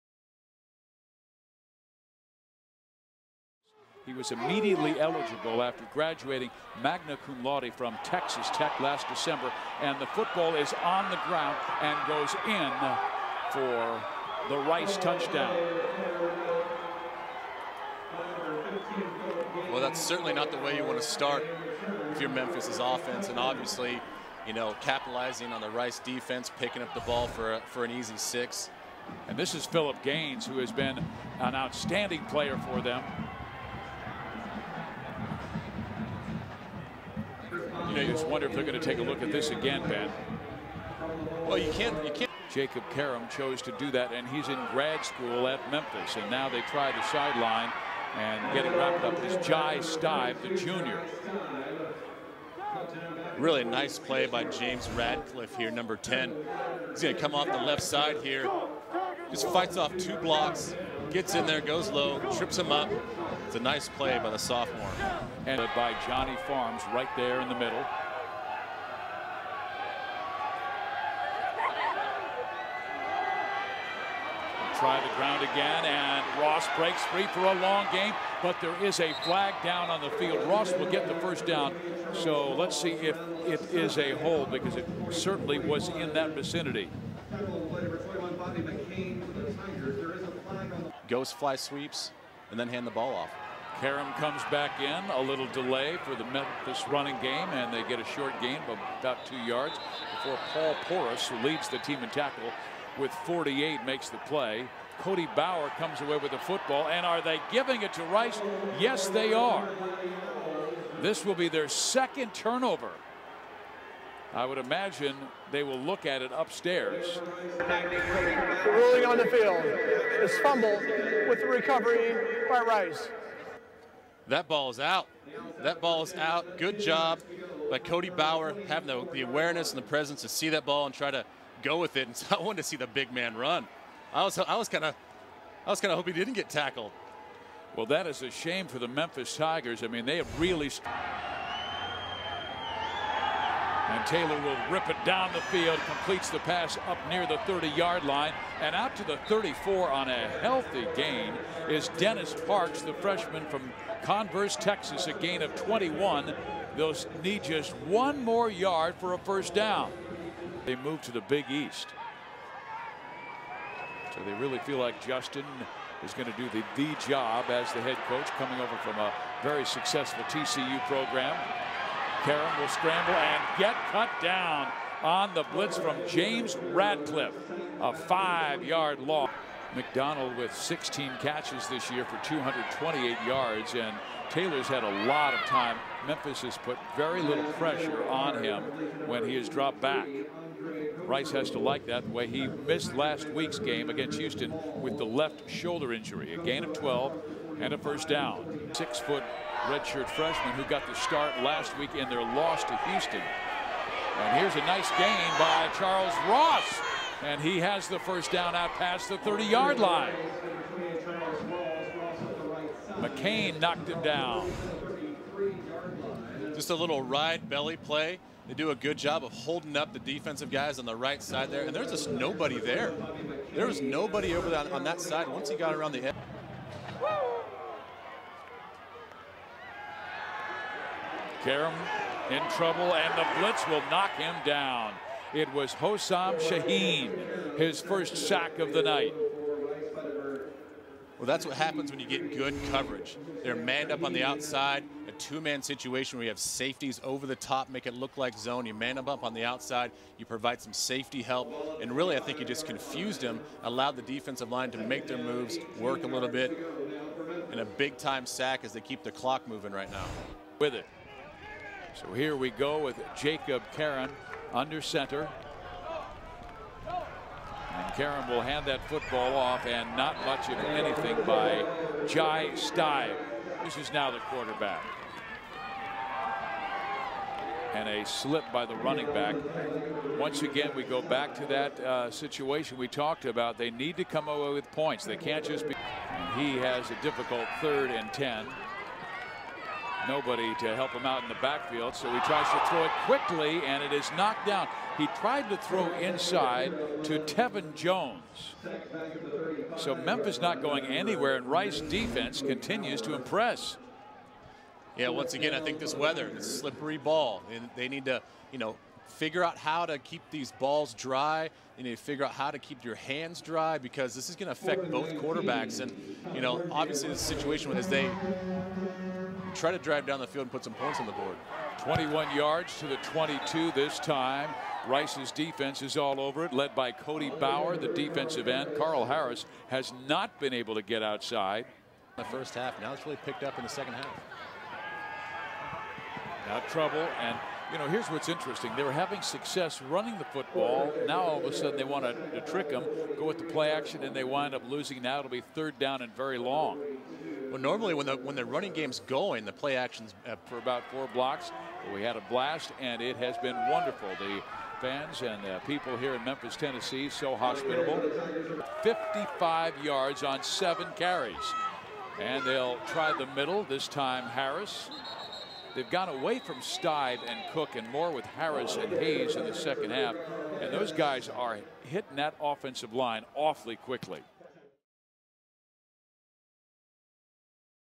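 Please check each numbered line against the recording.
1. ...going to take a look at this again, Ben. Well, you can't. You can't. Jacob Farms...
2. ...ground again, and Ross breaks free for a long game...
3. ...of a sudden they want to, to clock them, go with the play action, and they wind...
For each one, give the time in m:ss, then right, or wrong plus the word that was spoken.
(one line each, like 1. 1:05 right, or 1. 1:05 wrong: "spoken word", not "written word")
1. 0:38 wrong: "Karam", not "Farms"
2. 1:15 right
3. 5:41 wrong: "trick", not "clock".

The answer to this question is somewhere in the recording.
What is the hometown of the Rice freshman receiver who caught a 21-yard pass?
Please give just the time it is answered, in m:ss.
2:34.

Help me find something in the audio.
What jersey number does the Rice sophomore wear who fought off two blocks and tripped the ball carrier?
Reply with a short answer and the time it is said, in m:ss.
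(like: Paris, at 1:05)
10, at 0:55.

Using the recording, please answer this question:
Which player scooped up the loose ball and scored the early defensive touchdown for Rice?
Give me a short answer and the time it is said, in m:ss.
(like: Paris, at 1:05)
Phillip Gaines, at 0:29.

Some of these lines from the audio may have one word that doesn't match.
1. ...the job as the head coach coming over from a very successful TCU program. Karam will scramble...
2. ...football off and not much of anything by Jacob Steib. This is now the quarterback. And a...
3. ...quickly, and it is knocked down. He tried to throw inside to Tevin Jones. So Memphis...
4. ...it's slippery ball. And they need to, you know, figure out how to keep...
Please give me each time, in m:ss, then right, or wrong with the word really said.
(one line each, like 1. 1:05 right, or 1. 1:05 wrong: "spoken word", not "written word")
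1. 2:46 right
2. 4:28 wrong: "Jai", not "Jacob"
3. 4:53 right
4. 5:06 right.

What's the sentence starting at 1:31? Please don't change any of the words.
Ghost fly sweeps, and then hand the ball off.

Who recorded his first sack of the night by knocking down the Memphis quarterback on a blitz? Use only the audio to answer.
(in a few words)
Hosam Shahin.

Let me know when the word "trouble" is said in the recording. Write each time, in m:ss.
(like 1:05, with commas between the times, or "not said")
3:52, 5:36.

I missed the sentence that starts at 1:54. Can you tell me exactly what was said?
I would imagine they will look at it upstairs.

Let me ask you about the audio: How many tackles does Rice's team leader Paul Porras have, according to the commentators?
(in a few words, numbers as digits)
48.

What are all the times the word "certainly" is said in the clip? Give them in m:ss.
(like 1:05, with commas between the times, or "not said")
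0:20, 1:25.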